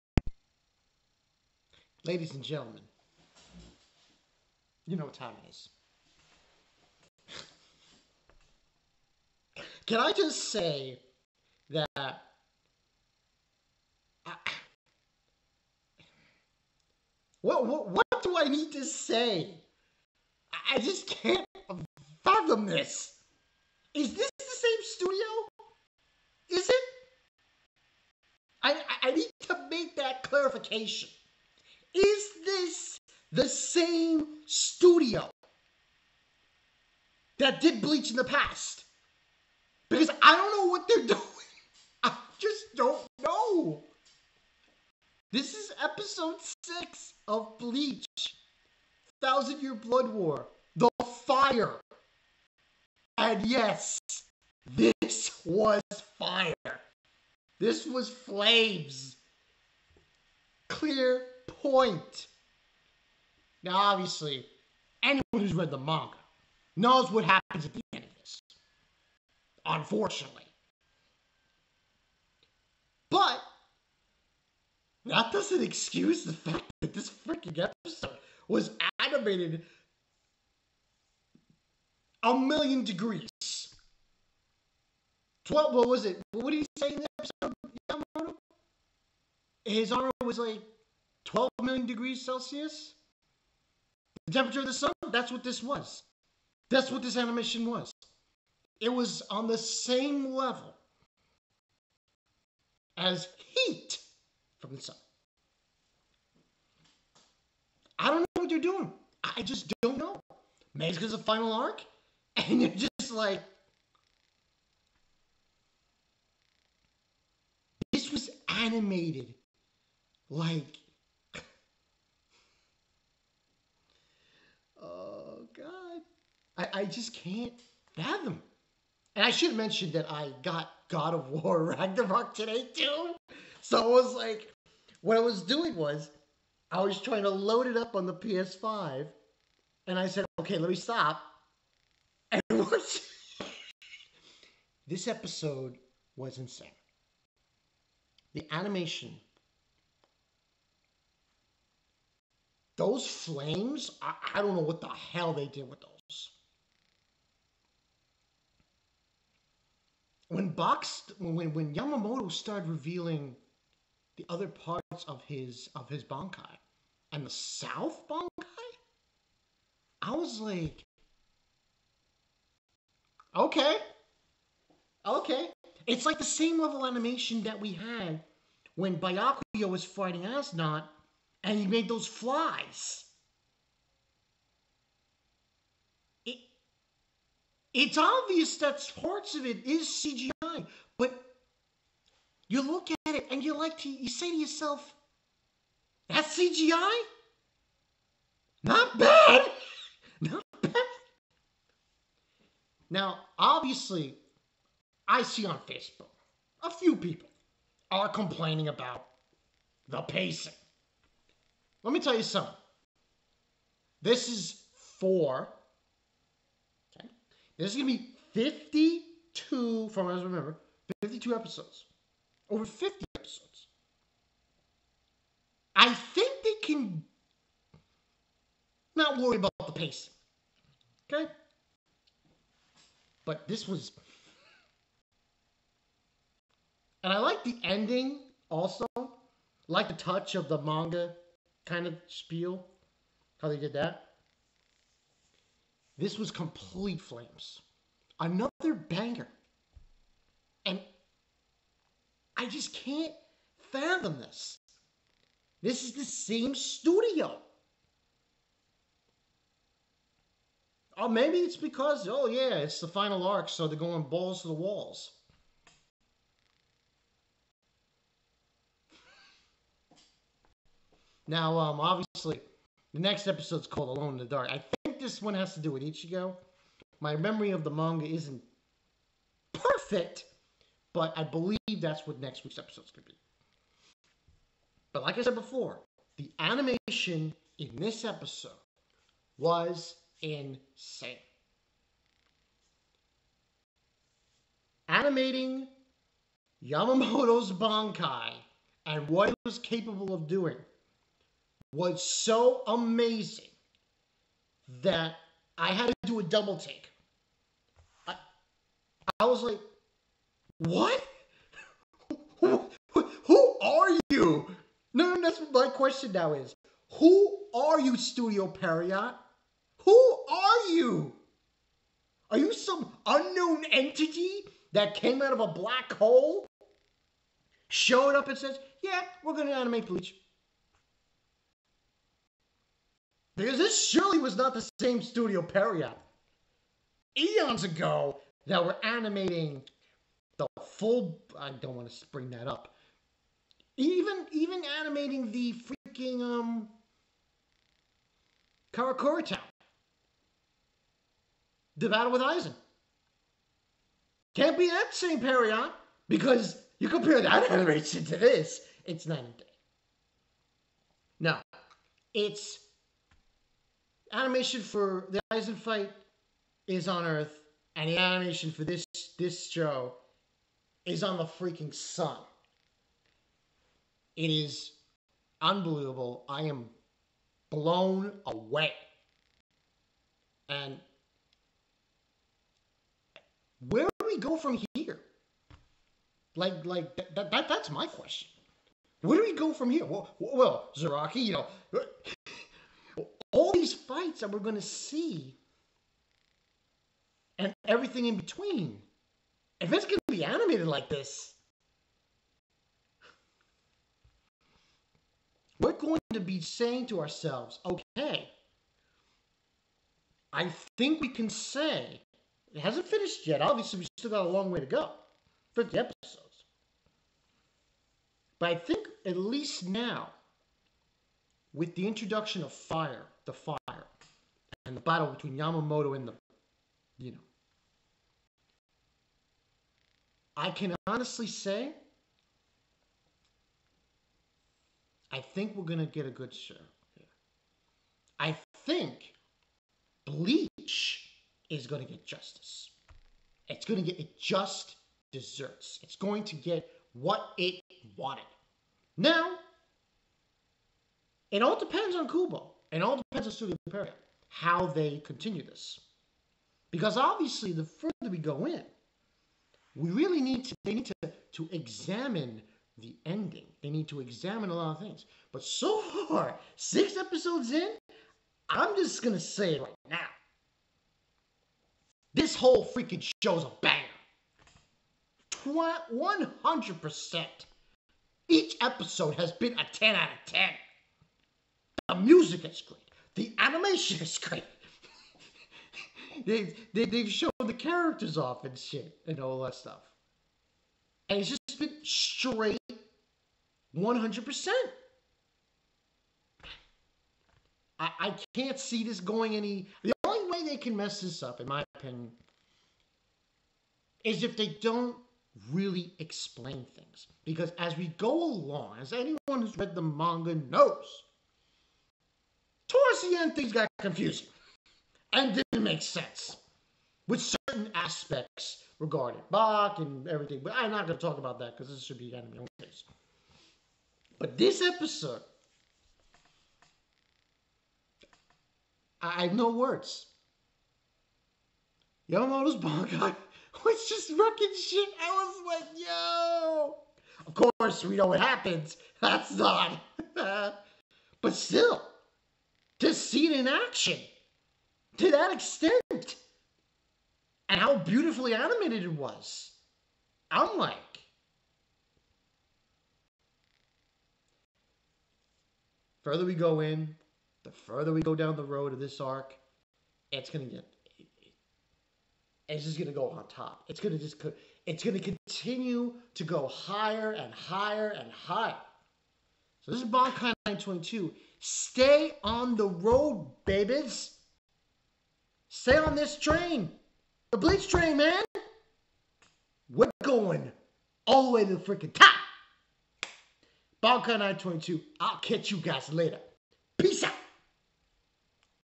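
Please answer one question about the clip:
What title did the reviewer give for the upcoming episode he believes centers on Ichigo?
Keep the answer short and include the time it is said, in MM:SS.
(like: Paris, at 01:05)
Alone in the Dark, at 04:33.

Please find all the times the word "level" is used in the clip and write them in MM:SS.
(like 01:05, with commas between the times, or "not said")
01:40, 02:56.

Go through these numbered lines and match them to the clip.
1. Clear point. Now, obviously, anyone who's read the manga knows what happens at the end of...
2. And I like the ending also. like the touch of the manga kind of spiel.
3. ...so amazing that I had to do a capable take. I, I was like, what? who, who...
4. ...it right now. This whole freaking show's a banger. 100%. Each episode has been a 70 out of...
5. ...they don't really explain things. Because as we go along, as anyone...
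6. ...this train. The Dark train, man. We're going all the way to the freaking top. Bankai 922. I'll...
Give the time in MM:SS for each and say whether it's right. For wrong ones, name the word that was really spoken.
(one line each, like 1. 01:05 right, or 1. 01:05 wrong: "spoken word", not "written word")
1. 01:00 right
2. 03:57 right
3. 05:02 wrong: "double", not "capable"
4. 07:49 wrong: "10", not "70"
5. 08:24 right
6. 09:35 wrong: "Bleach", not "Dark".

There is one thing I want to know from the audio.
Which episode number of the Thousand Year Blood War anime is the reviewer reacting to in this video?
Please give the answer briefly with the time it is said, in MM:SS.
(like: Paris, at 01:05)
6, at 00:45.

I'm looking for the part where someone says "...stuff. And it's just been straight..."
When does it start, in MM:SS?
08:09.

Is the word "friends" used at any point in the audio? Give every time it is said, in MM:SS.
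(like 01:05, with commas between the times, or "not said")
not said.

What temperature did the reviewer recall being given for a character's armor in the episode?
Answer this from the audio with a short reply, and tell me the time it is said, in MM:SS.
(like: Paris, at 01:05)
12 million degrees Celsius, at 01:31.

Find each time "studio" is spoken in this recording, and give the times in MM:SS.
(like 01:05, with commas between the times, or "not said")
00:24, 00:34, 04:16, 05:17, 05:35, 07:33.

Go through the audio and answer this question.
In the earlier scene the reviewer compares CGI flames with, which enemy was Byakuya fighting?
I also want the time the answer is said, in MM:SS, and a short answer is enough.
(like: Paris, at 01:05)
As Nodt, at 03:00.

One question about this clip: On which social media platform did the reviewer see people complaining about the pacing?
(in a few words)
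Facebook.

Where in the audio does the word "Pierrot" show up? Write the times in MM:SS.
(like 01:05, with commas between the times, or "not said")
05:18, 05:35, 05:55.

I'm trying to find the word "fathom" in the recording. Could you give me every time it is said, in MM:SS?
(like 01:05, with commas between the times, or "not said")
00:22, 02:07, 04:13.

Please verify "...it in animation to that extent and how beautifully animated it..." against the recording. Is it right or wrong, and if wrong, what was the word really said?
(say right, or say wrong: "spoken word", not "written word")
wrong: "action", not "animation".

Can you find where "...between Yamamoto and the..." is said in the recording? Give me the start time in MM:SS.
07:05.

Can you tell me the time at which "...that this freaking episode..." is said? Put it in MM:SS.
01:16.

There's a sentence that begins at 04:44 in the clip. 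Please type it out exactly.
But like I said before, the animation in this episode was insane.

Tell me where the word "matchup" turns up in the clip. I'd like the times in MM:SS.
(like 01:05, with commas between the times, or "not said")
not said.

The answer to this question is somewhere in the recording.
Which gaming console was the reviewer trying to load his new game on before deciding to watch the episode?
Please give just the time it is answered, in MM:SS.
02:18.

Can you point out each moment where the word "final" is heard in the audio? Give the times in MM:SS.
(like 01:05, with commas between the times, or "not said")
01:51, 04:22.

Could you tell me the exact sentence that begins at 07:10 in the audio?
I can honestly say, I think we're going to get a good show here.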